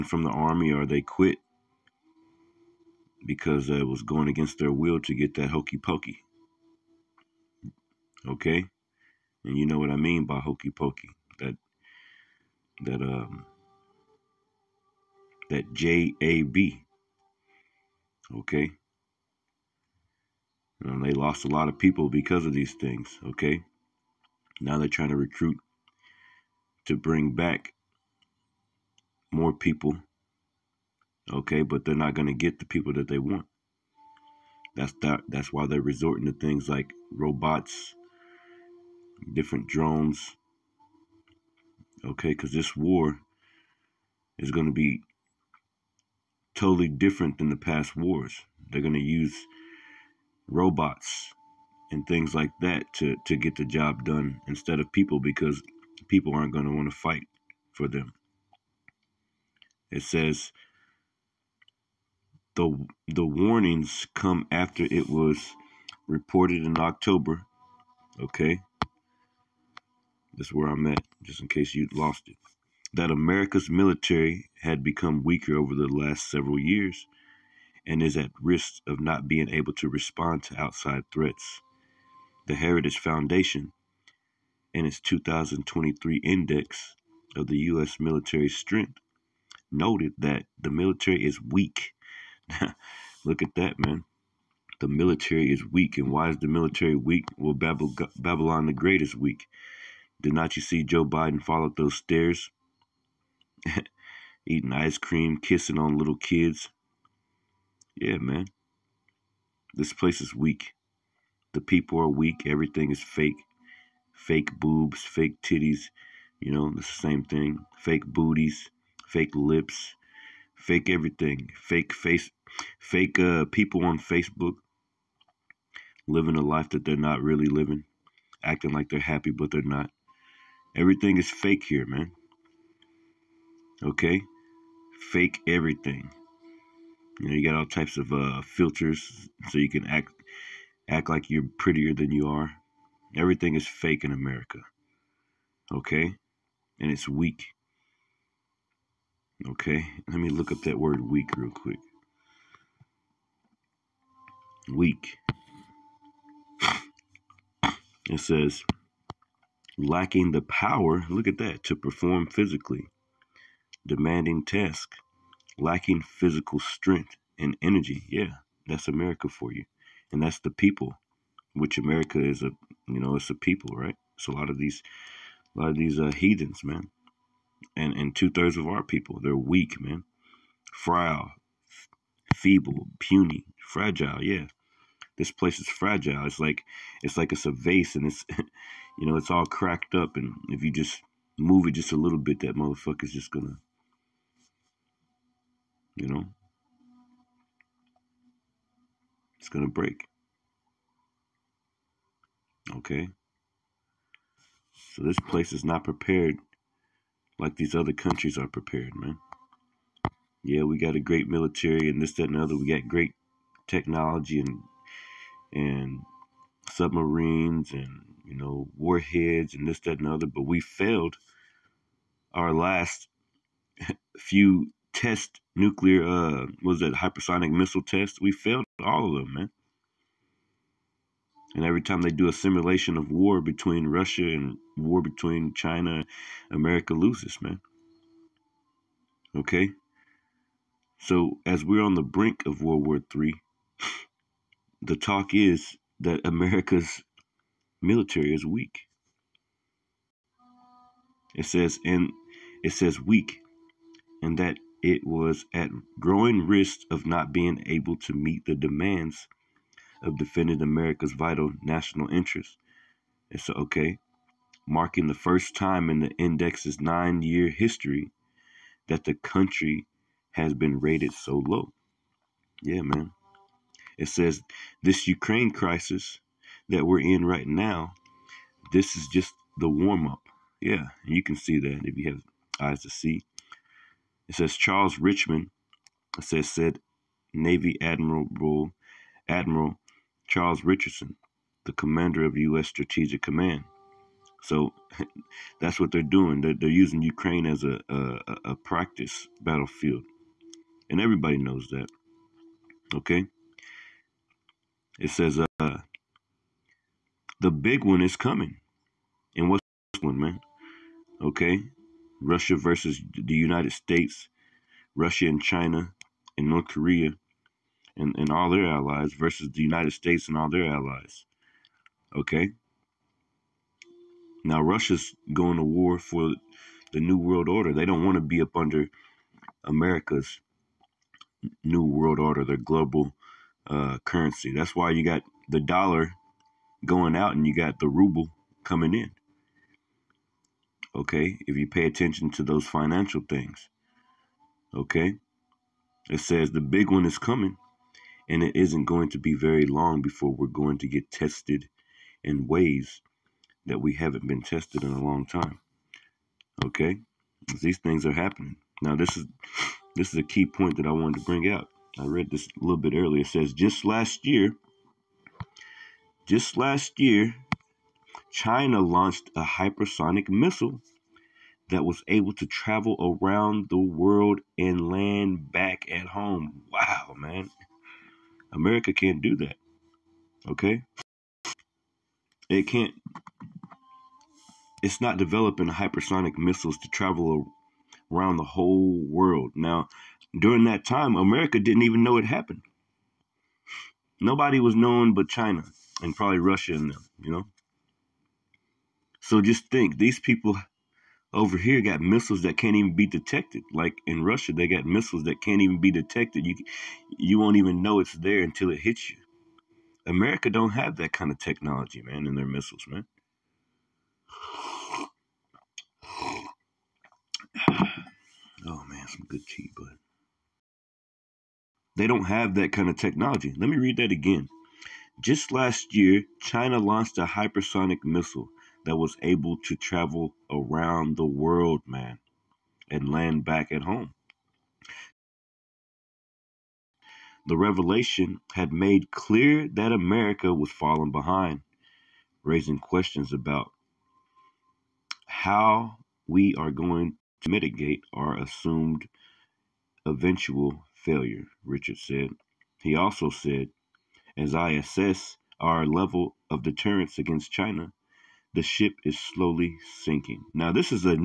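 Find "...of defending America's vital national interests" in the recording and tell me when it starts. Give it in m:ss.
4:20.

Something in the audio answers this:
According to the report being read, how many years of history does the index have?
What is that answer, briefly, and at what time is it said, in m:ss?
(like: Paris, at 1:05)
9, at 4:26.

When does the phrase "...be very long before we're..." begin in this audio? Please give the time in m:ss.
5:49.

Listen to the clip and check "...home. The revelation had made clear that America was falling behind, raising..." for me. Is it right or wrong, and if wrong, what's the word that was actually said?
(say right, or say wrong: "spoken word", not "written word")
right.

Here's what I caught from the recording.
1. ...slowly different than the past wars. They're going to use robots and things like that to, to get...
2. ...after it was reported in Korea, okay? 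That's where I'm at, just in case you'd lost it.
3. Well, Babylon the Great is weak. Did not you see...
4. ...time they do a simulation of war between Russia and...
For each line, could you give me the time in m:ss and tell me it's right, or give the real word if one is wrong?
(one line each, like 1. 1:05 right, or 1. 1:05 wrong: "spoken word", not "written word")
1. 0:46 wrong: "totally", not "slowly"
2. 1:04 wrong: "October", not "Korea"
3. 1:37 right
4. 3:51 right.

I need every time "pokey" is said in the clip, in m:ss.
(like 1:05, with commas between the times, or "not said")
0:05, 0:10.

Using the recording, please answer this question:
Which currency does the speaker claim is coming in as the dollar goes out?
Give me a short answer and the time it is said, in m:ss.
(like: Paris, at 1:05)
Ruble, at 5:37.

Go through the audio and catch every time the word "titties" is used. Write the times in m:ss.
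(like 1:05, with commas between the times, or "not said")
1:55.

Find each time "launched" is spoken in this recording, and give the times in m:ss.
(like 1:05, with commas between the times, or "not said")
6:08, 7:06.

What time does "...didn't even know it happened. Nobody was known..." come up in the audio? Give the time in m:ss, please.
6:31.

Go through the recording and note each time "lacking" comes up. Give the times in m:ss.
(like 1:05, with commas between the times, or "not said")
2:39, 2:45.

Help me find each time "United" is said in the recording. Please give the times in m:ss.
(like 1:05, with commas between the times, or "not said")
5:13, 5:19.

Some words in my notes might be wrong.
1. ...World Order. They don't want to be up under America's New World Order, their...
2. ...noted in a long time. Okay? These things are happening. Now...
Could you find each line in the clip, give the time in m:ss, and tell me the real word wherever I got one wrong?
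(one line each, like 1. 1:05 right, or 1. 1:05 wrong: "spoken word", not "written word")
1. 5:27 right
2. 5:54 wrong: "tested", not "noted".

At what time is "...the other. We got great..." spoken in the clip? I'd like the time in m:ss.
3:32.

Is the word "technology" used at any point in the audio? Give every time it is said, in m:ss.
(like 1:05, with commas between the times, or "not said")
3:33, 6:51, 7:02.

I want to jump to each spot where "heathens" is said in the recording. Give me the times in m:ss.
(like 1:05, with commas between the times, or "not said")
2:56.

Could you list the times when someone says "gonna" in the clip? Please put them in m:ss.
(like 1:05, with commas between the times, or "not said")
3:13, 3:19.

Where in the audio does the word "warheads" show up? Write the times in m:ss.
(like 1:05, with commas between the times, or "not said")
3:38.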